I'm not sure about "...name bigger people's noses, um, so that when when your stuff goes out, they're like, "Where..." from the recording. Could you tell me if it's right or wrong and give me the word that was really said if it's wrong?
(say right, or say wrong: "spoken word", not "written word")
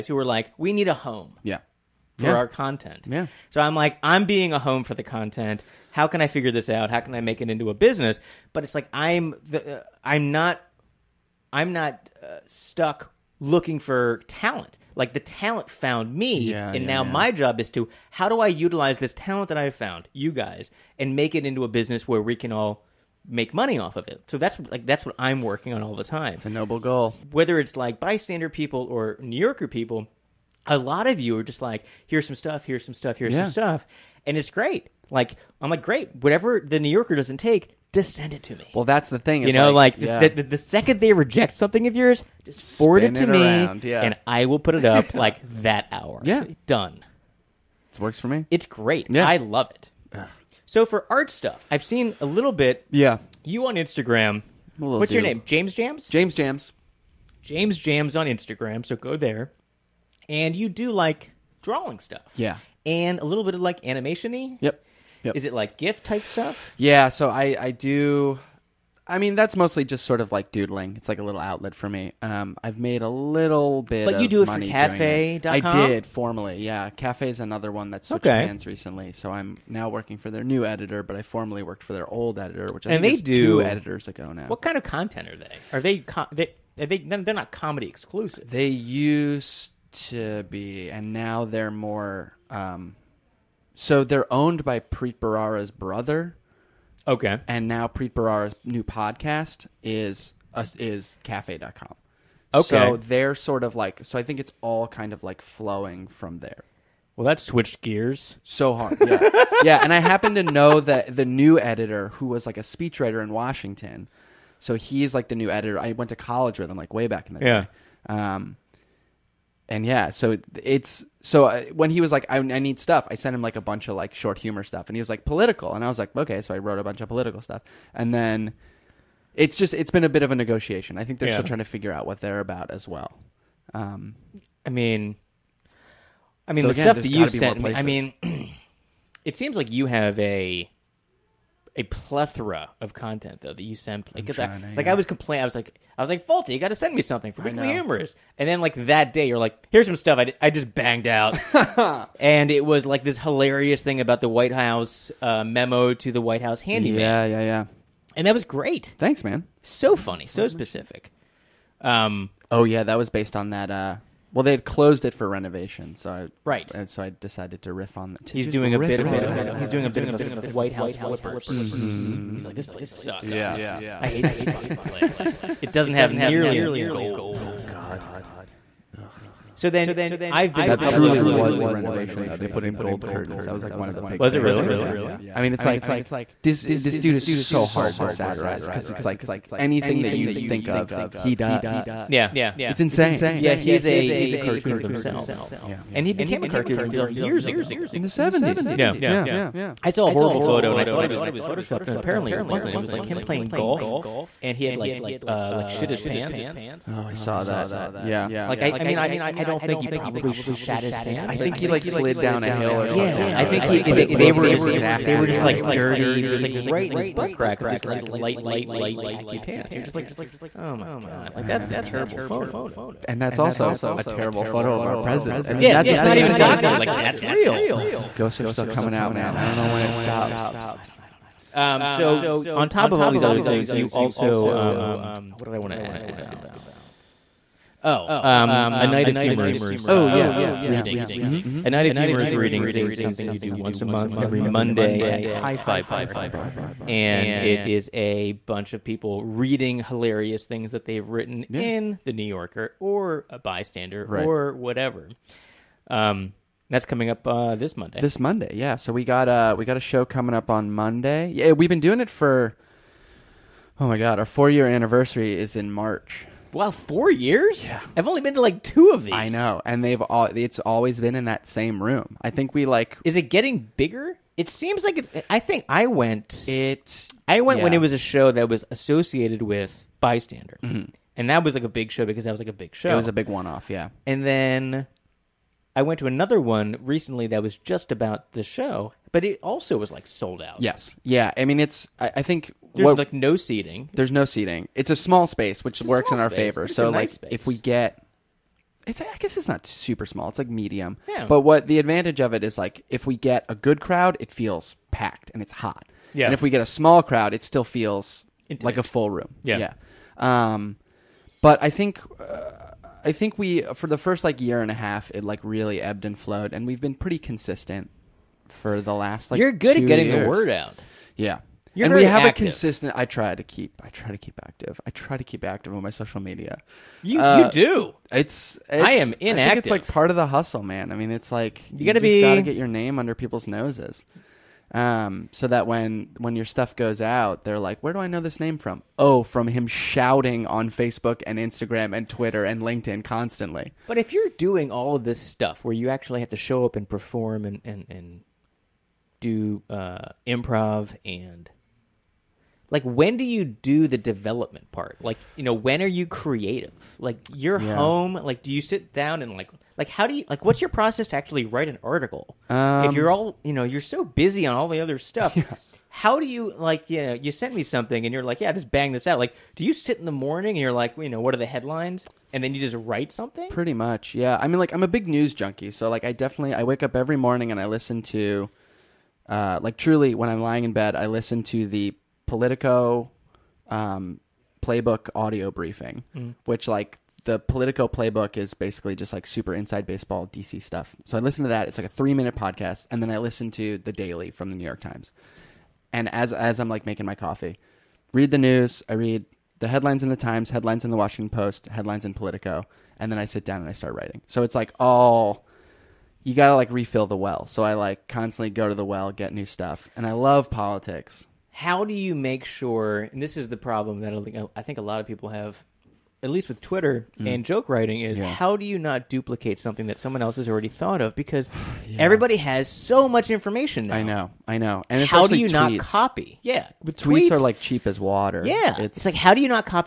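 wrong: "under", not "bigger".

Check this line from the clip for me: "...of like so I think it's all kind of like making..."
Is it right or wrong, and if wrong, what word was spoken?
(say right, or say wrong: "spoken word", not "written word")
wrong: "flowing", not "making".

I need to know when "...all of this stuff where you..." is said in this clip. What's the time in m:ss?
5:44.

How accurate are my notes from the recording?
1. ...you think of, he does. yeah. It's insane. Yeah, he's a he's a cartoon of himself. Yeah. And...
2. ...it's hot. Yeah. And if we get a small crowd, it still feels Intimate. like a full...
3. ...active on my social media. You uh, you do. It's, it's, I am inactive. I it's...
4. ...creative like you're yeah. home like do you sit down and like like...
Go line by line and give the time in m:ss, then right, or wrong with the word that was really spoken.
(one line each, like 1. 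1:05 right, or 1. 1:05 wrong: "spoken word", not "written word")
1. 3:10 right
2. 5:05 right
3. 5:25 right
4. 5:56 right.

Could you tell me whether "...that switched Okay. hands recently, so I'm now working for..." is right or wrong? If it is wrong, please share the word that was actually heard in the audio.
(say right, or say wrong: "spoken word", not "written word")
right.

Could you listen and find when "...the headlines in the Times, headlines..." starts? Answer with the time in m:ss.
6:39.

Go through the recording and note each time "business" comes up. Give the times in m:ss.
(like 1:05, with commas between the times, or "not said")
0:07, 0:21.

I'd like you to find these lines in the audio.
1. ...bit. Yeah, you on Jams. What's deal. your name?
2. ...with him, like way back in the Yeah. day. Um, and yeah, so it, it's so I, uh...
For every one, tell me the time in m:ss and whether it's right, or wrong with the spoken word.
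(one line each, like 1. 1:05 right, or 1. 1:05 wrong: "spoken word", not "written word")
1. 0:52 wrong: "Instagram", not "Jams"
2. 1:56 right.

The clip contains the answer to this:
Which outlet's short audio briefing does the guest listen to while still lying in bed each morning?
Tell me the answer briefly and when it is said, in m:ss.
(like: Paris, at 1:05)
Politico Playbook, at 6:22.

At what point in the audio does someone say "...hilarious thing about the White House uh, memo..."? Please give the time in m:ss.
2:33.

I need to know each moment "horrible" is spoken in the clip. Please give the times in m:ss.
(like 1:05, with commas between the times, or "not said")
3:20.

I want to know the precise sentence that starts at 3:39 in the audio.
You're just like, Oh my god!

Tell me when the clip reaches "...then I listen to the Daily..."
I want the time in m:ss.
6:33.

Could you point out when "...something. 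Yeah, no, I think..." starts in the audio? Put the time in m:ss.
3:32.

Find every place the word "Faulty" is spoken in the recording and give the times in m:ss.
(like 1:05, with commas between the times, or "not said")
2:26.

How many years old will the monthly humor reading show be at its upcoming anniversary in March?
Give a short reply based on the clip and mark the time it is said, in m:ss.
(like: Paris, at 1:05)
4, at 4:24.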